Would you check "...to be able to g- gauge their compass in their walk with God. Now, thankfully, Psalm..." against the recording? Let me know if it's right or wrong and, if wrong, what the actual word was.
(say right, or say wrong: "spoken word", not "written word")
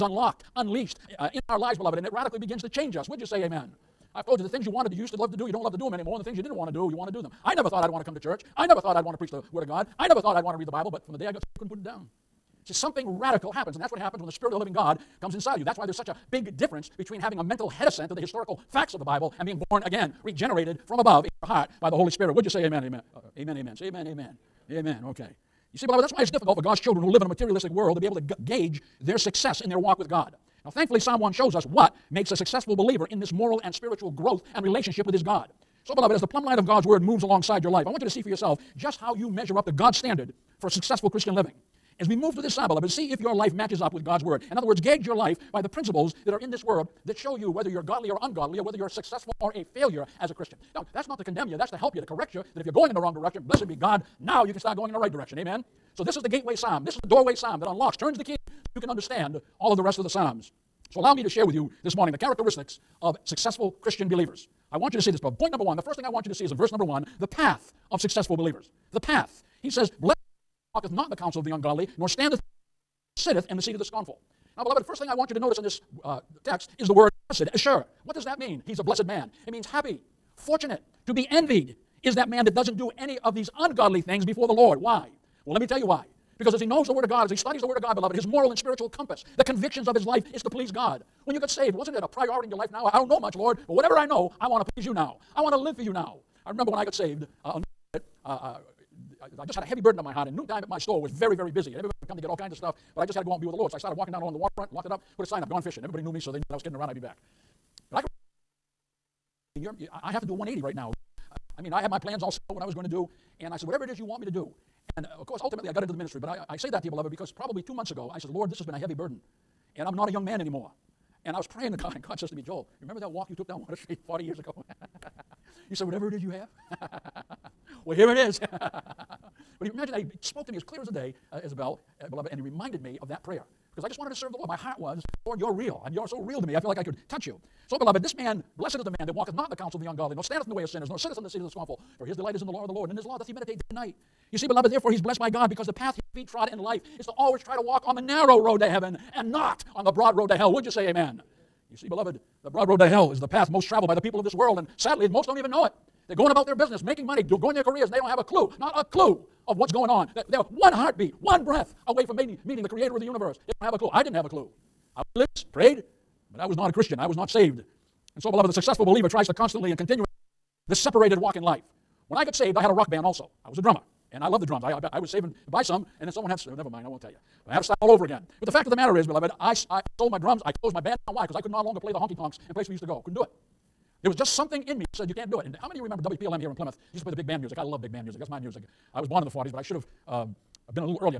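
wrong: "success", not "compass".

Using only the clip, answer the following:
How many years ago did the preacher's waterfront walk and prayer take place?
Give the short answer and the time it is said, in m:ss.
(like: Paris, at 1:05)
40, at 2:04.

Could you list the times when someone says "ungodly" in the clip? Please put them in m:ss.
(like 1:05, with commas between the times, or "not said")
0:48, 1:11, 1:23, 2:19.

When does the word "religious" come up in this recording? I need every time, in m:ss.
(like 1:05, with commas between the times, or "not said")
2:45.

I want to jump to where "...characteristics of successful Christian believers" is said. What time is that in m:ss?
1:02.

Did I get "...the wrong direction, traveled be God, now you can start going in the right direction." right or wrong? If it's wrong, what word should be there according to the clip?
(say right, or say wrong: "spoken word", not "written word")
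wrong: "blessed", not "traveled".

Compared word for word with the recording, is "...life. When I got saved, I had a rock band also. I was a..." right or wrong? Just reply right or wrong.
right.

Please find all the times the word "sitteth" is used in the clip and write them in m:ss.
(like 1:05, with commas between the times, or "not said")
1:13, 2:20.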